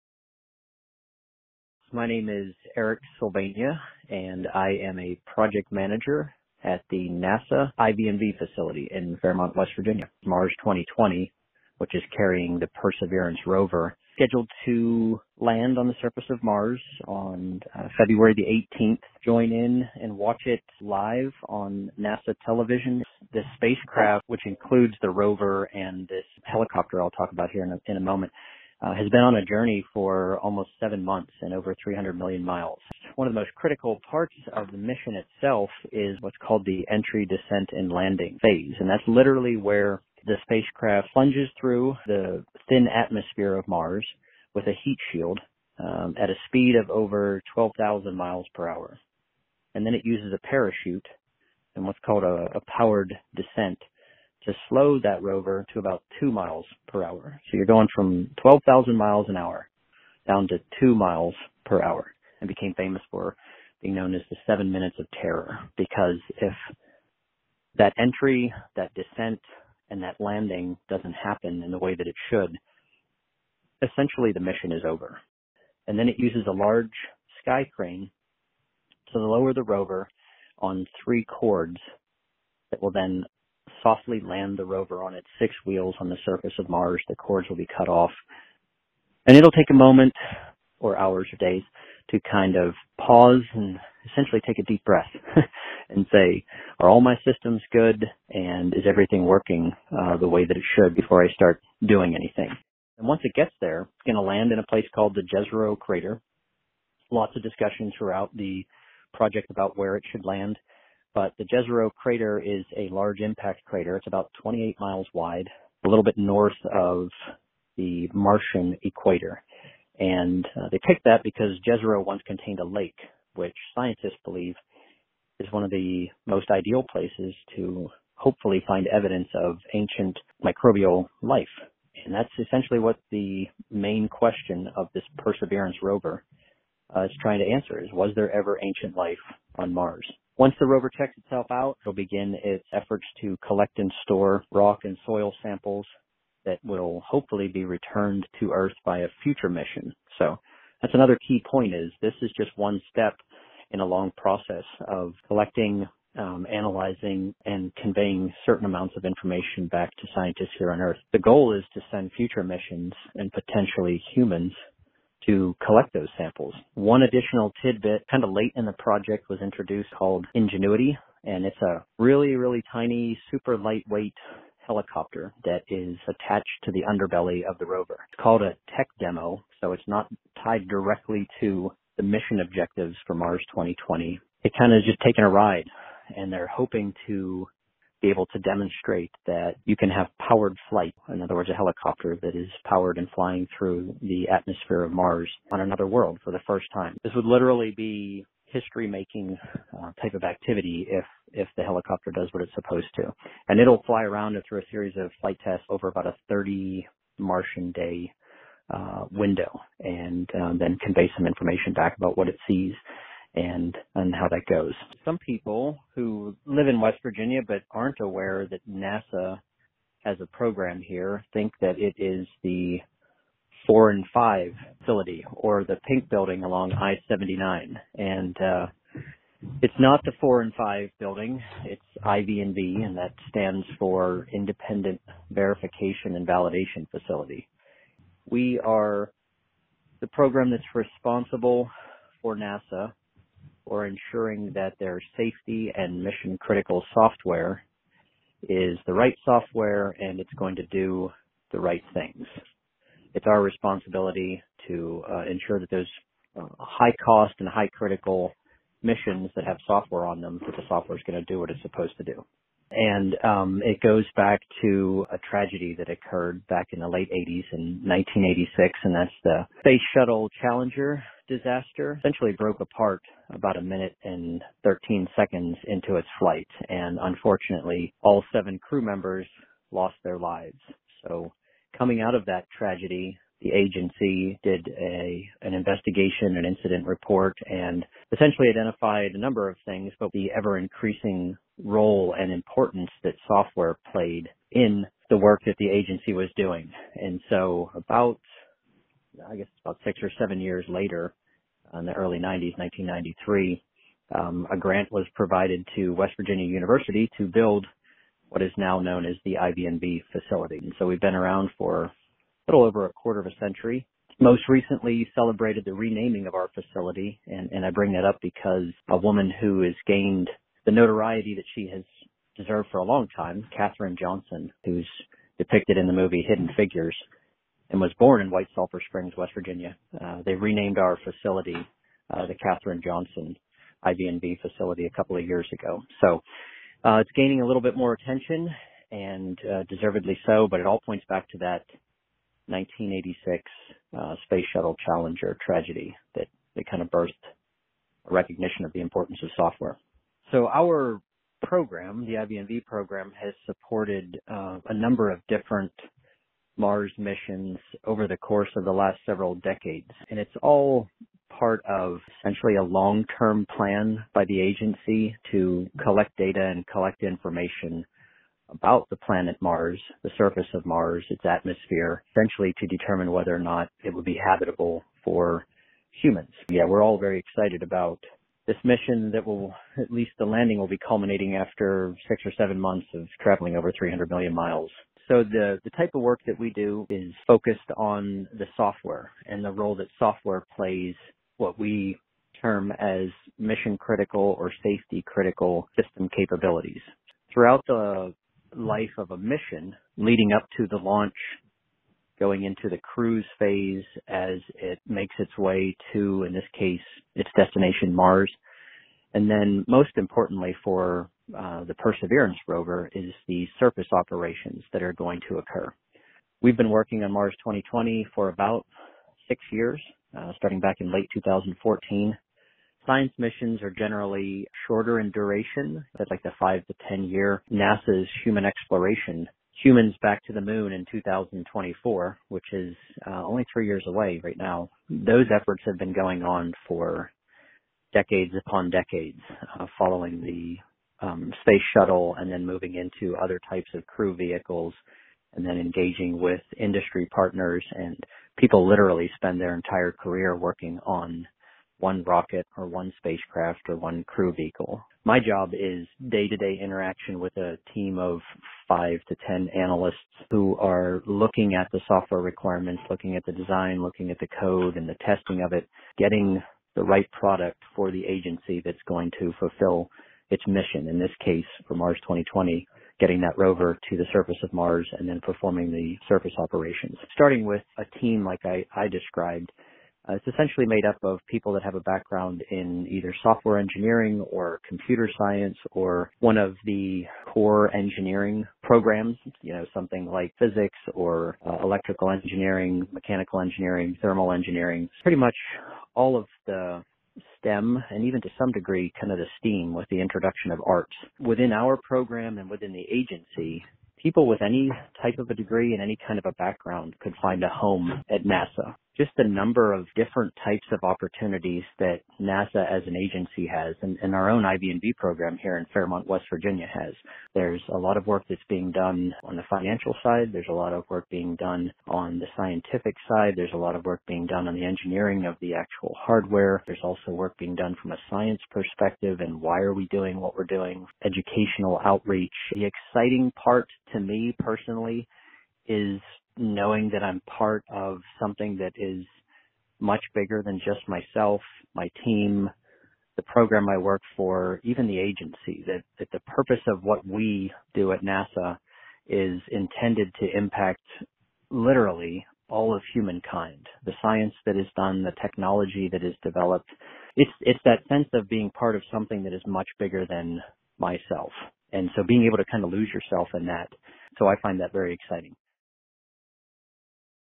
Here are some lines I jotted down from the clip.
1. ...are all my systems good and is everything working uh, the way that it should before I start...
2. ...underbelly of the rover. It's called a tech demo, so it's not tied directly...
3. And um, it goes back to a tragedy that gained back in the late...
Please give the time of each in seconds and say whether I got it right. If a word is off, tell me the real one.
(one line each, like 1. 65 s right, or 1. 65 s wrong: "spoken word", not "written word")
1. 96 s right
2. 176 s right
3. 262 s wrong: "occurred", not "gained".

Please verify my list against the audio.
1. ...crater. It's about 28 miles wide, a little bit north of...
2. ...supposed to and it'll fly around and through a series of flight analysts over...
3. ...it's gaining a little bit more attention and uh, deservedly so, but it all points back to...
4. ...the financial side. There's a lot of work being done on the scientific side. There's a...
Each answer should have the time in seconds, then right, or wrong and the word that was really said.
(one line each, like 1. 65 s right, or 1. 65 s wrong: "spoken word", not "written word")
1. 113 s right
2. 202 s wrong: "tests", not "analysts"
3. 336 s right
4. 519 s right.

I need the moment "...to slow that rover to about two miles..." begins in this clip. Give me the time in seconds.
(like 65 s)
54 s.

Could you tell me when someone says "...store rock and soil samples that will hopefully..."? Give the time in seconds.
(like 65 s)
144 s.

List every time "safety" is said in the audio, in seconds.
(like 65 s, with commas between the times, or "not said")
245 s, 394 s.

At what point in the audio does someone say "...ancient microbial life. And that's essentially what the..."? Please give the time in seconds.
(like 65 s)
129 s.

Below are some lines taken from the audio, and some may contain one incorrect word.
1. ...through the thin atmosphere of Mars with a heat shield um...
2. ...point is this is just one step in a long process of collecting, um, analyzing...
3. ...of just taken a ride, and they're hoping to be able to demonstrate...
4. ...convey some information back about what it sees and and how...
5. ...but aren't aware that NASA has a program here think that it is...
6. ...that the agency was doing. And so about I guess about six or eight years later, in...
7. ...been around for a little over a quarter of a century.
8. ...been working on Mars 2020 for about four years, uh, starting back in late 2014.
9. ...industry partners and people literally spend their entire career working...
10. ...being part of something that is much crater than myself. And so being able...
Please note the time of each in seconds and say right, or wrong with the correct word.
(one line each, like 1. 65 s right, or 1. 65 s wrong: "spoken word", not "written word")
1. 41 s right
2. 151 s right
3. 184 s right
4. 210 s right
5. 217 s right
6. 295 s wrong: "seven", not "eight"
7. 311 s right
8. 416 s wrong: "six", not "four"
9. 446 s right
10. 558 s wrong: "bigger", not "crater".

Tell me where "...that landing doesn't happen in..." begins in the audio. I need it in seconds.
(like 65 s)
70 s.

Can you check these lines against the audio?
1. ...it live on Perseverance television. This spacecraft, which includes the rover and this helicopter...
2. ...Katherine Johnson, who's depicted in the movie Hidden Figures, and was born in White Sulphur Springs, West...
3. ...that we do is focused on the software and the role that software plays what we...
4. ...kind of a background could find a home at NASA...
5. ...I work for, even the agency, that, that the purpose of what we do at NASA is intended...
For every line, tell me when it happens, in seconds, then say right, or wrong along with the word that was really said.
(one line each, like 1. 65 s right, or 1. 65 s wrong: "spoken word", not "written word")
1. 20 s wrong: "NASA", not "Perseverance"
2. 323 s right
3. 386 s right
4. 506 s right
5. 543 s right.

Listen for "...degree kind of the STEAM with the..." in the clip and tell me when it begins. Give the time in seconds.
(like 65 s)
498 s.